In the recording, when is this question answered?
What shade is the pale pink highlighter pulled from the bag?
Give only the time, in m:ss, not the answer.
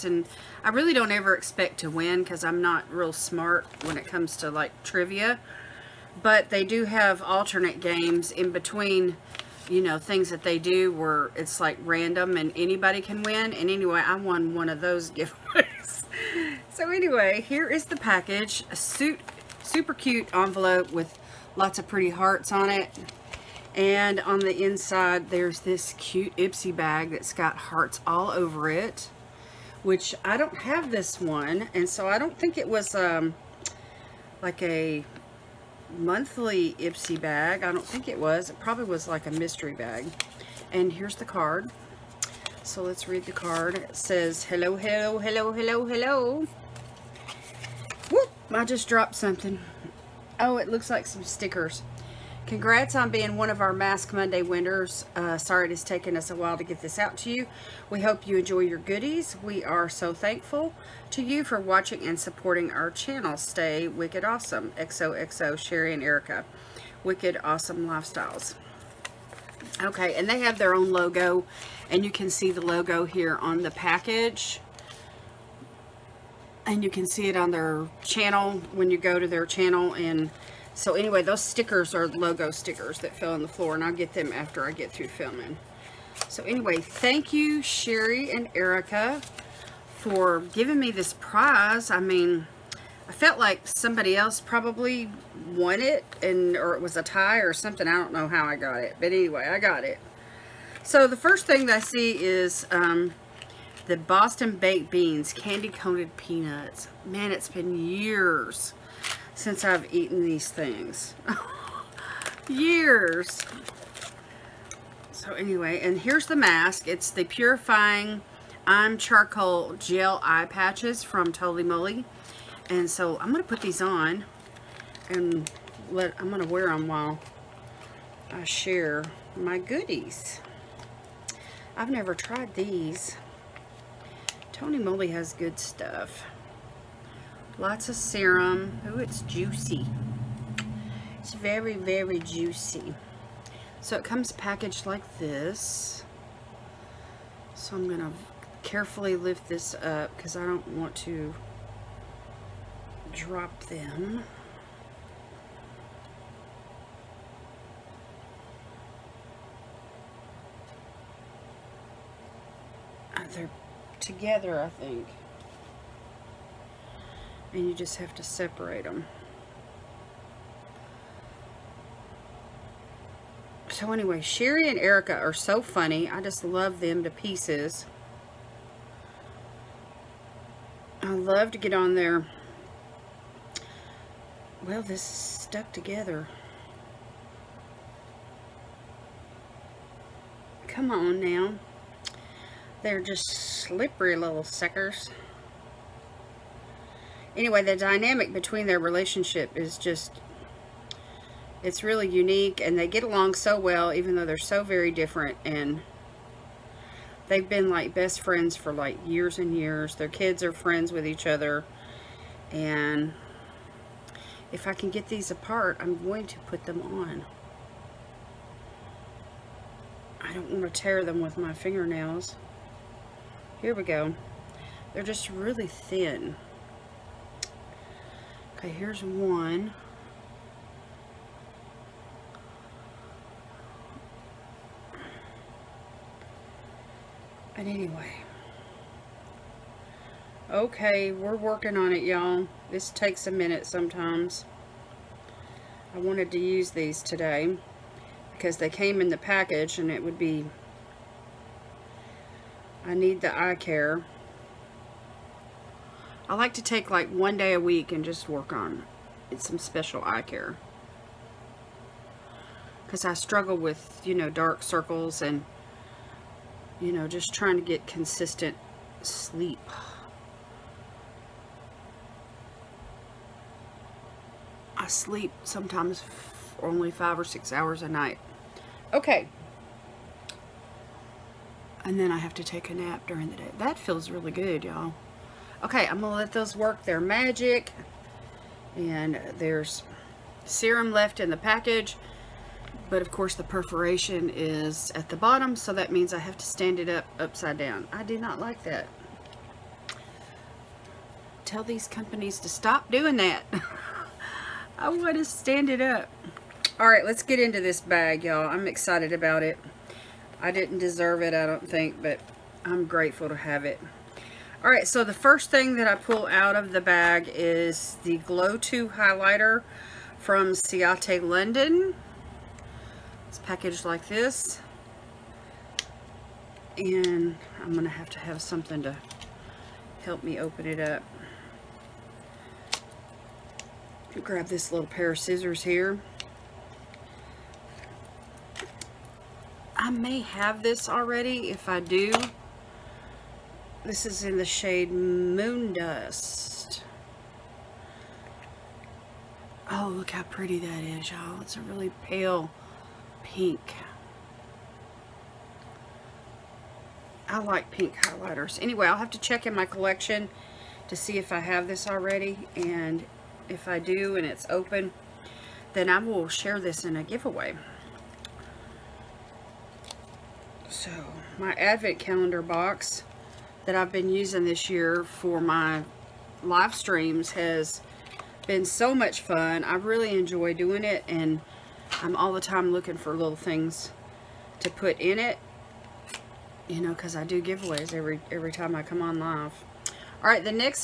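5:44.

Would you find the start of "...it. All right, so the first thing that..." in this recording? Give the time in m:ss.
5:13.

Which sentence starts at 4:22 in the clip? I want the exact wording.
Because I struggle with, you know, dark circles and, you know, just trying to get consistent sleep.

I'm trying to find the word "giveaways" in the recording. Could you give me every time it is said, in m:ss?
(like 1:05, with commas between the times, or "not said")
0:15, 6:07, 6:27.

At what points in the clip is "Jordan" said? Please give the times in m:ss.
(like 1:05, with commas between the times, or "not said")
not said.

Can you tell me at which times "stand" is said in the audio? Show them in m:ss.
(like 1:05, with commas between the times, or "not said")
4:56, 5:05.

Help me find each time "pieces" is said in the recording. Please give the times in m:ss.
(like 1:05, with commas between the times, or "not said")
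2:57.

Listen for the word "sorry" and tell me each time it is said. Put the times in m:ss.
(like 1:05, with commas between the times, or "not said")
0:55.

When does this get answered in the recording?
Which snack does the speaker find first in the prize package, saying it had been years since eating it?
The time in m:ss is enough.
1:43.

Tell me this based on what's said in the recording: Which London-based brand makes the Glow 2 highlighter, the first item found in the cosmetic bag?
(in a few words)
Ciate London.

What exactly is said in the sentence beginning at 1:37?
I don't know how I got it, but anyway, I got it.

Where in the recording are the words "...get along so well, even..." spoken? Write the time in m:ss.
3:22.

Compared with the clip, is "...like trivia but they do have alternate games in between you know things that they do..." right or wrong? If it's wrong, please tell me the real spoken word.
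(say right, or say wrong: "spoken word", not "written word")
right.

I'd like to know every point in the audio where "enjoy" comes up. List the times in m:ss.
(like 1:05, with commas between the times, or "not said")
0:58, 6:20.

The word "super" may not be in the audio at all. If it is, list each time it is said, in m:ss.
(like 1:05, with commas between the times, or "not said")
0:19.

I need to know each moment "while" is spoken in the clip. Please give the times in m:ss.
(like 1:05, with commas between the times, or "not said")
0:56, 2:06.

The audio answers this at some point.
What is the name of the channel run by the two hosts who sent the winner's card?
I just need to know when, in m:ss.
1:07.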